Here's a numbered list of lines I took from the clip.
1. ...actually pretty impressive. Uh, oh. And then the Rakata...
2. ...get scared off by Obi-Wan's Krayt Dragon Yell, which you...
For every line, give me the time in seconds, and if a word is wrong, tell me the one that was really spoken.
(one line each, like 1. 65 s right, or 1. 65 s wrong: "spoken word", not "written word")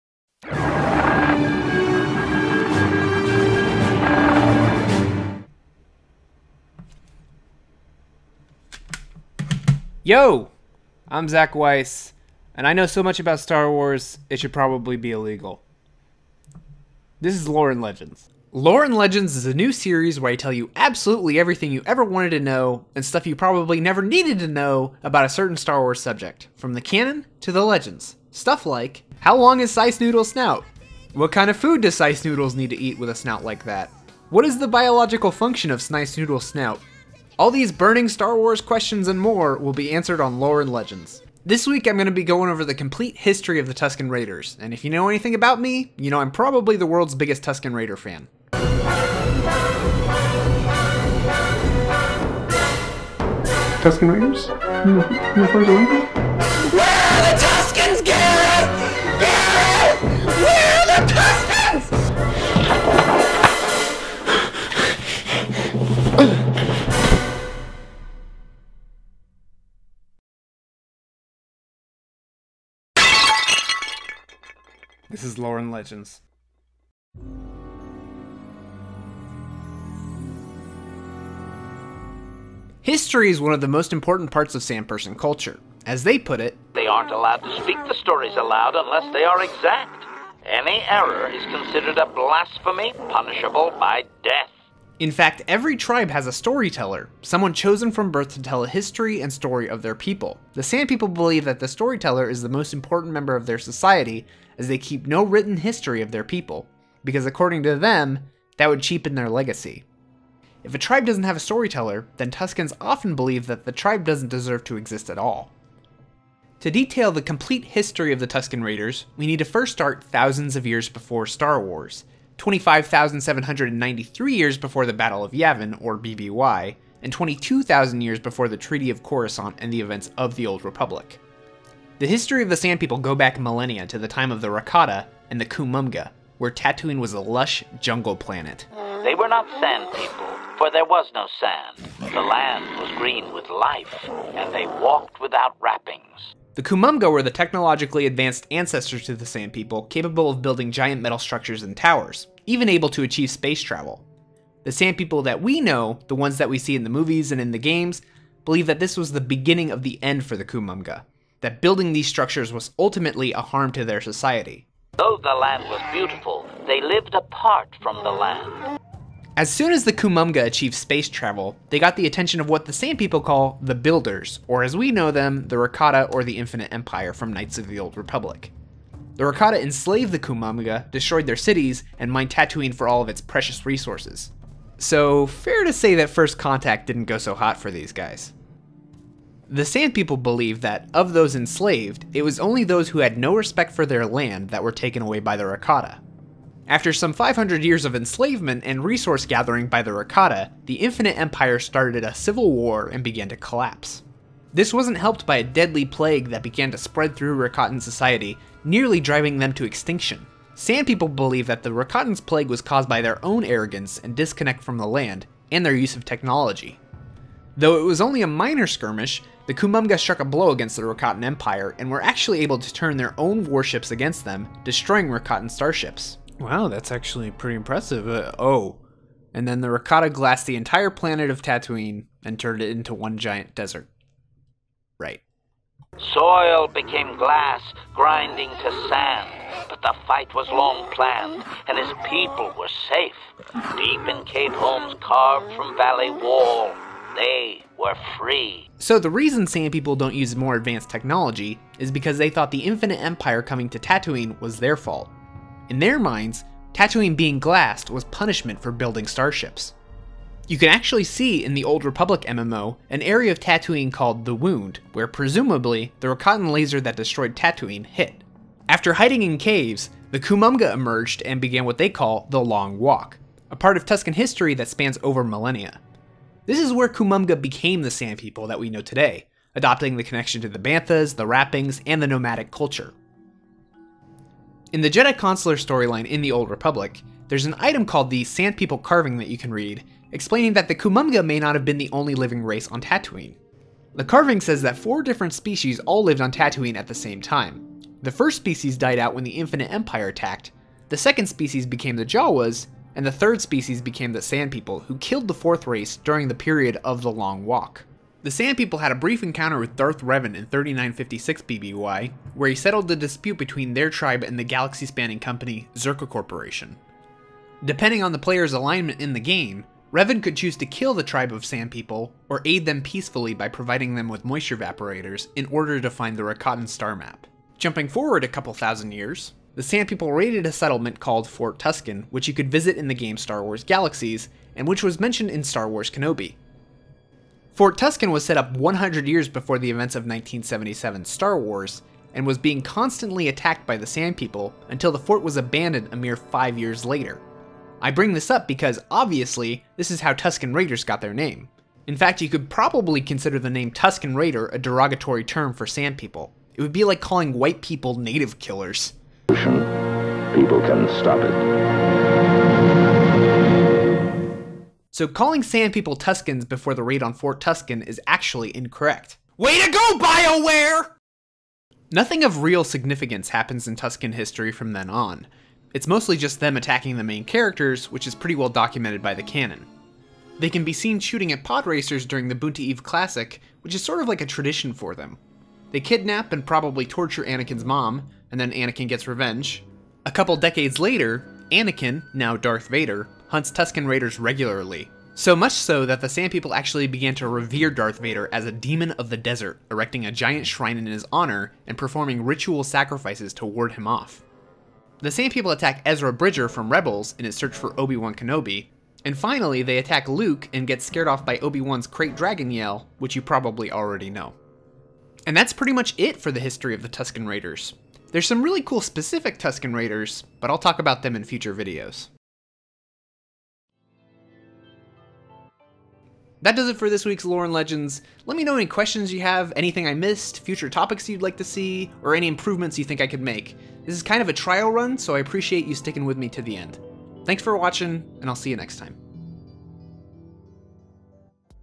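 1. 226 s right
2. 410 s right.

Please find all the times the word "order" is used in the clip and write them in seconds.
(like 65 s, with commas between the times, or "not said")
325 s.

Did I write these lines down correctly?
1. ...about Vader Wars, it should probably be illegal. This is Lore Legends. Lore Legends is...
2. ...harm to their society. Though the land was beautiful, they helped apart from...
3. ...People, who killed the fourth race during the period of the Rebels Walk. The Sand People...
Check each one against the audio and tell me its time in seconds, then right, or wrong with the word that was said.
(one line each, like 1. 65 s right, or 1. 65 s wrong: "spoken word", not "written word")
1. 13 s wrong: "Star", not "Vader"
2. 163 s wrong: "lived", not "helped"
3. 304 s wrong: "Long", not "Rebels".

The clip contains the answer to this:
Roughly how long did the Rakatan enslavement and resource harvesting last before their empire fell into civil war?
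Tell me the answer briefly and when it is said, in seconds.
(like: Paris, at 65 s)
500 years, at 197 s.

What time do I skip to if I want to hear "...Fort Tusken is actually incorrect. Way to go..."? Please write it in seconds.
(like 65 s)
367 s.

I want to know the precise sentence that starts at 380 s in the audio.
They can be seen shooting at pod racers during the Boonta Eve Classic, which is sort of like a tradition for them.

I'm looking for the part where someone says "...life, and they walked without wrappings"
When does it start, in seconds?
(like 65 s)
143 s.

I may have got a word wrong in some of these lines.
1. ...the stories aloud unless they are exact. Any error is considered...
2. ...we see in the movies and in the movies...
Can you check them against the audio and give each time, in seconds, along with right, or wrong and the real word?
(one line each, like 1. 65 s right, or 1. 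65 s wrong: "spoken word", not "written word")
1. 87 s right
2. 156 s wrong: "games", not "movies".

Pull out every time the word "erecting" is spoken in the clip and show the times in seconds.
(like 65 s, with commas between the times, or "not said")
399 s.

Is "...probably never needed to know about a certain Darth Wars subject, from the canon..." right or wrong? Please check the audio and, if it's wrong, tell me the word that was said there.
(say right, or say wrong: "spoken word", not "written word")
wrong: "Star", not "Darth".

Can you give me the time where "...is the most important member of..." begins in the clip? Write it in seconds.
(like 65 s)
102 s.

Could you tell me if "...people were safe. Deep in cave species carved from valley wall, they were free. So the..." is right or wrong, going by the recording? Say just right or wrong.
wrong.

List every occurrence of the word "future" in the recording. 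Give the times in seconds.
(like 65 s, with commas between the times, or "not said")
421 s, 430 s.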